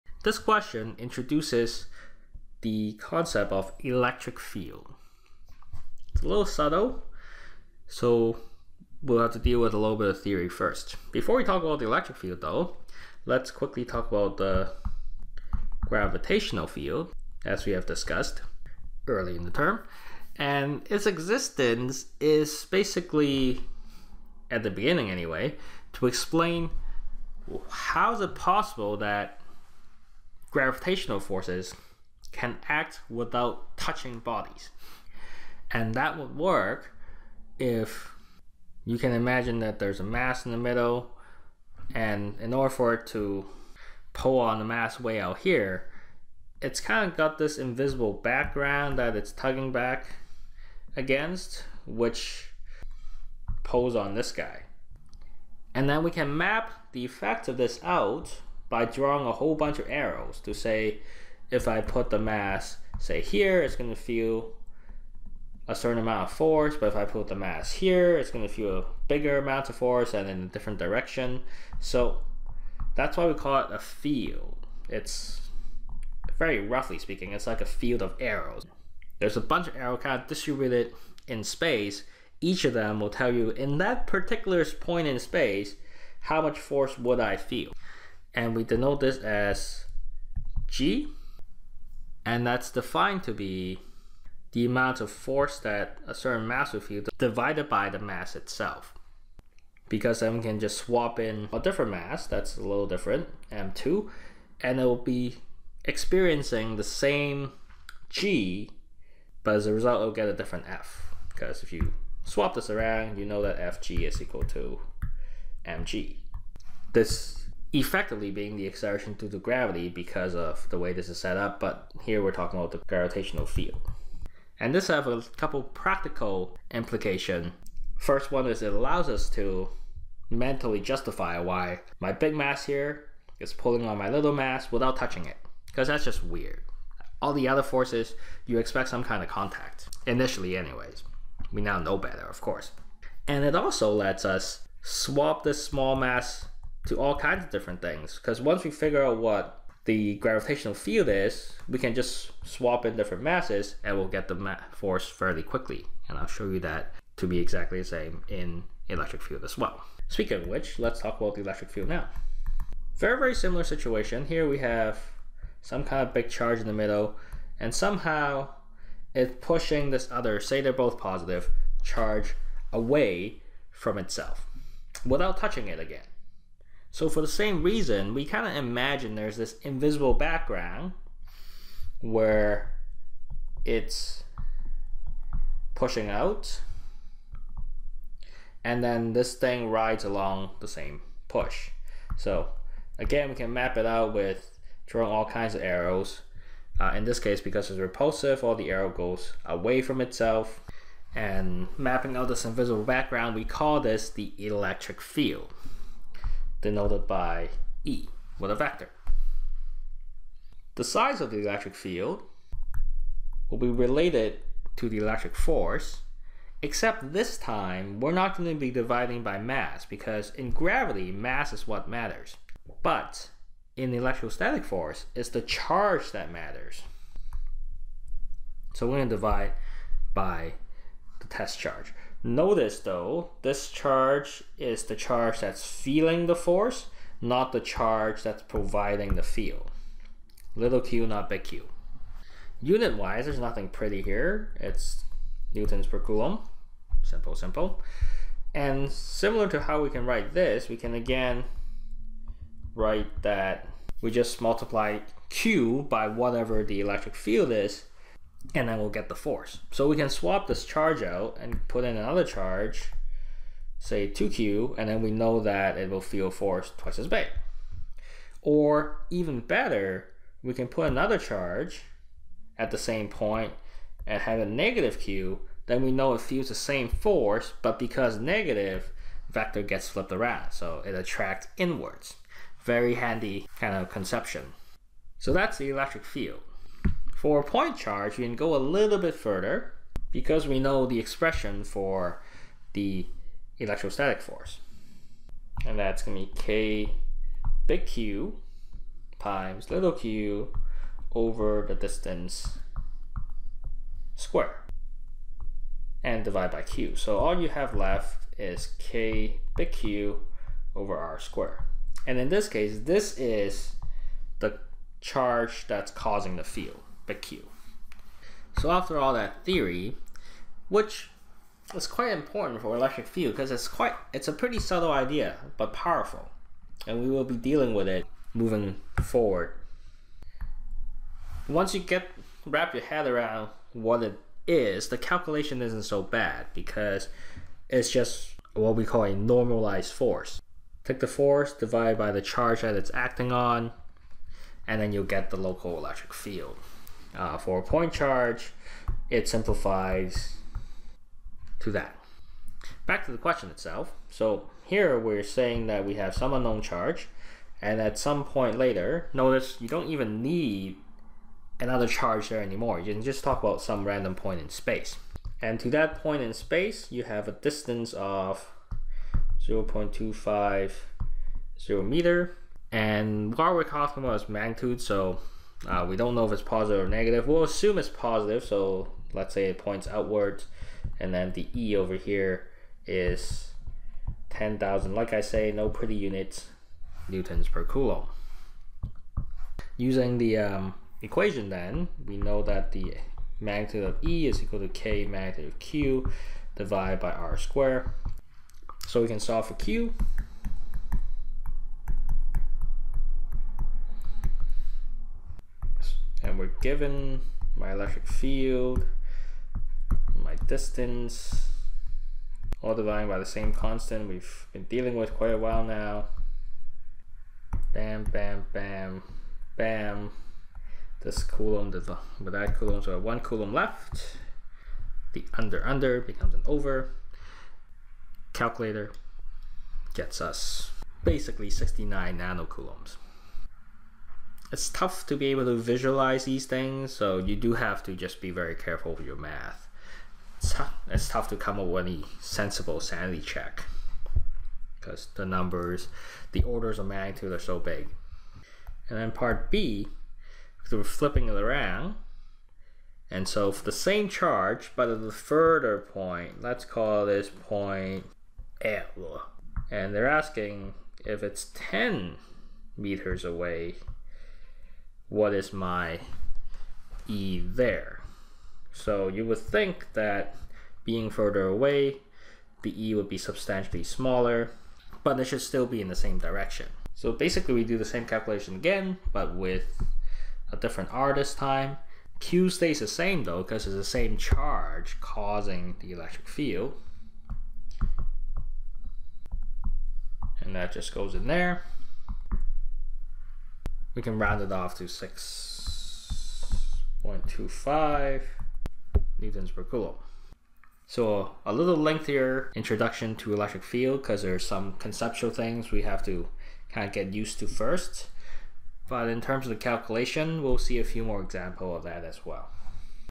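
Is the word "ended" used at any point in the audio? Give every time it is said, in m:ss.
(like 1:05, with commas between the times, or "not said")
not said.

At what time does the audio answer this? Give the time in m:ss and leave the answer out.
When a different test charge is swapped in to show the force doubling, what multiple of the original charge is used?
4:24.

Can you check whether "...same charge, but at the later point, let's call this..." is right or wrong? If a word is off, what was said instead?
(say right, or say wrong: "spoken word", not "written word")
wrong: "further", not "later".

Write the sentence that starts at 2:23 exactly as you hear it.
And it also lets us swap this small mass to all kinds of different things.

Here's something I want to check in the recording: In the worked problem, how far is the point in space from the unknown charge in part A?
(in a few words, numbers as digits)
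0.250 meter.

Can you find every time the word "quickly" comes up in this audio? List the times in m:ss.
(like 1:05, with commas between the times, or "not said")
0:13, 2:35.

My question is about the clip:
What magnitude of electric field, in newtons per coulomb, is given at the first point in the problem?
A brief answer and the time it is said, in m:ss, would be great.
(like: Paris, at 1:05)
10,000, at 6:24.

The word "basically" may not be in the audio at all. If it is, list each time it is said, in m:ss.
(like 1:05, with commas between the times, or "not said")
0:22, 7:11, 7:57.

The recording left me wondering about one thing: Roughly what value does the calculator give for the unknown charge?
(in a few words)
69 nanocoulombs.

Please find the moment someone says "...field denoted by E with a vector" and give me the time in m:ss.
3:25.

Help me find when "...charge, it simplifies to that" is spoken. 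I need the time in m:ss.
5:47.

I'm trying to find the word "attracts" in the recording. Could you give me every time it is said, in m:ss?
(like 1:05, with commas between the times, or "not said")
4:40.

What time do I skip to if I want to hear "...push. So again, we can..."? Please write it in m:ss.
3:11.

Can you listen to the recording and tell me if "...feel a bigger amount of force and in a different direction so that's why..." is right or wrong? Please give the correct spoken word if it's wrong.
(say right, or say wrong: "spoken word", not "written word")
right.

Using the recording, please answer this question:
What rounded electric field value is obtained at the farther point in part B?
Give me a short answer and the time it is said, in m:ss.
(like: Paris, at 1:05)
6.25 newtons per coulomb, at 8:14.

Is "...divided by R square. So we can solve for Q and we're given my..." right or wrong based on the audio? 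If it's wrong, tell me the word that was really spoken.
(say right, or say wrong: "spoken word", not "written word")
right.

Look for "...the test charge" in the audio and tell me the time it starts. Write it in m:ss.
3:51.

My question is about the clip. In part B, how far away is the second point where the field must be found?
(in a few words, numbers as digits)
10 meters.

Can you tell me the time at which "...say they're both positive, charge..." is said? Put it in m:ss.
2:50.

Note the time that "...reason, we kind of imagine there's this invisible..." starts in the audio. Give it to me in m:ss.
2:57.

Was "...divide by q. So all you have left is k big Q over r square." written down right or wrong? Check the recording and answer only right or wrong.
right.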